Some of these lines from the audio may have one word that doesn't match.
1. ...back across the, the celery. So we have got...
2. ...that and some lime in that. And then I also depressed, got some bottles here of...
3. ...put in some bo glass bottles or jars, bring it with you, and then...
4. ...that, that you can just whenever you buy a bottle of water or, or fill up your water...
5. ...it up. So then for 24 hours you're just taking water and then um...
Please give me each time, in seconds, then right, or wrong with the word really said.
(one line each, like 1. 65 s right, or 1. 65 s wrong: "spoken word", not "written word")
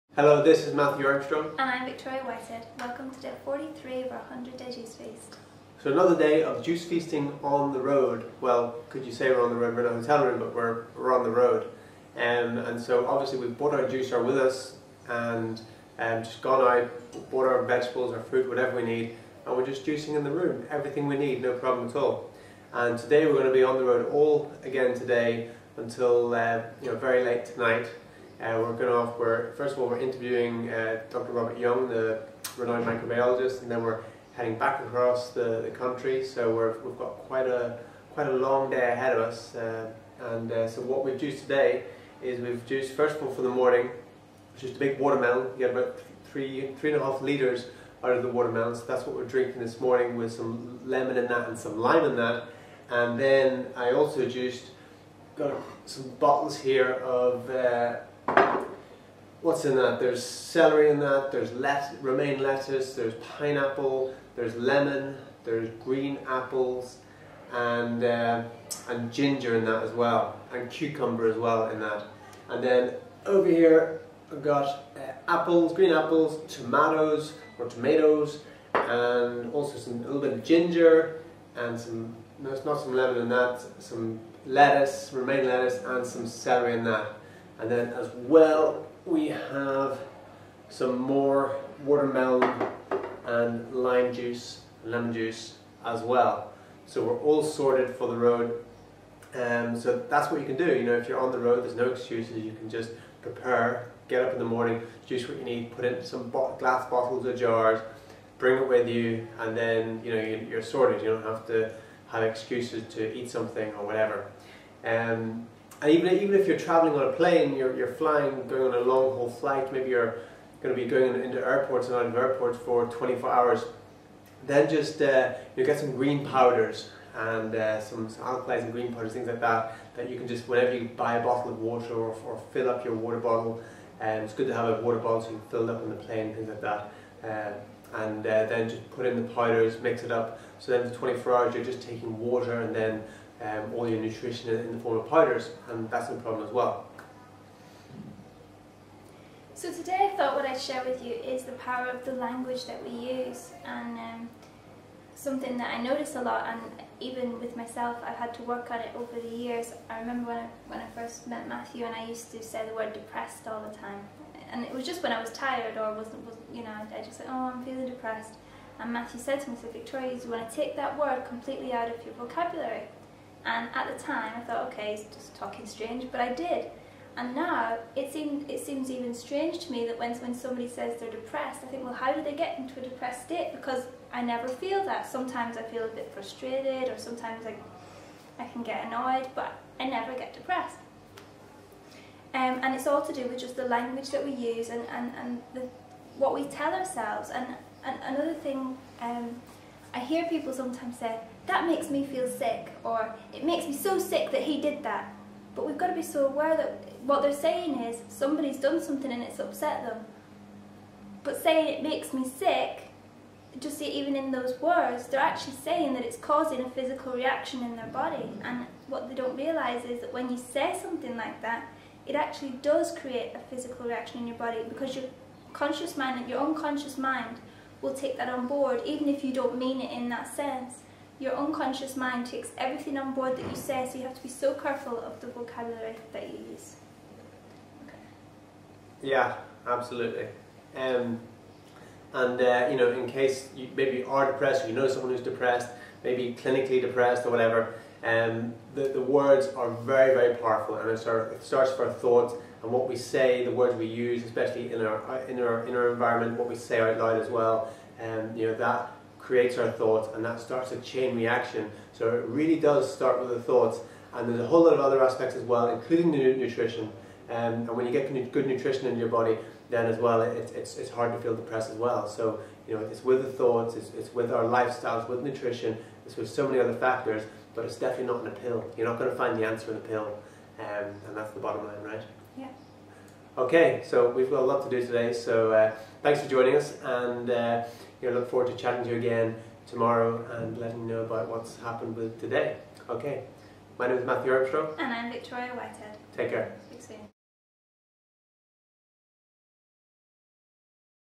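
1. 34 s wrong: "country", not "celery"
2. 51 s wrong: "juiced", not "depressed"
3. 105 s right
4. 129 s right
5. 140 s right.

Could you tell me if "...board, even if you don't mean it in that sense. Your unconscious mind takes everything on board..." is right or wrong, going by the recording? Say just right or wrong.
right.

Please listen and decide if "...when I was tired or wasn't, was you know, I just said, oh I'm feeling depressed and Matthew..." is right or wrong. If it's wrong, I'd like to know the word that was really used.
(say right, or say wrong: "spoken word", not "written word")
right.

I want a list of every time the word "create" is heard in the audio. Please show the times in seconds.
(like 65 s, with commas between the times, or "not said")
222 s, 259 s.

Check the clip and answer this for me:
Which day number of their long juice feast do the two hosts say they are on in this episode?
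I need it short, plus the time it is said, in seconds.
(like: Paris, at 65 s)
43, at 3 s.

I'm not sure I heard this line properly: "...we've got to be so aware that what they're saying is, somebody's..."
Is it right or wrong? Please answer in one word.
right.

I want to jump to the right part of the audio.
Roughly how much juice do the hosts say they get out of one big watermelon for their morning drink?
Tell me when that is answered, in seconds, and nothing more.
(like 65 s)
46 s.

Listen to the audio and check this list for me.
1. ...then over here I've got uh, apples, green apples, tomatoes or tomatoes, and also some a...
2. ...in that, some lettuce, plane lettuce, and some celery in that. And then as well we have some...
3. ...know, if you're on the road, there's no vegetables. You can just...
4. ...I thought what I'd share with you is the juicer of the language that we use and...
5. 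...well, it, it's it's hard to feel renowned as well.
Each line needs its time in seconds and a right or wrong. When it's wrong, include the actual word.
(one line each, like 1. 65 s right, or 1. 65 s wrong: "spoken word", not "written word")
1. 72 s right
2. 83 s wrong: "romaine", not "plane"
3. 100 s wrong: "excuses", not "vegetables"
4. 150 s wrong: "power", not "juicer"
5. 269 s wrong: "depressed", not "renowned".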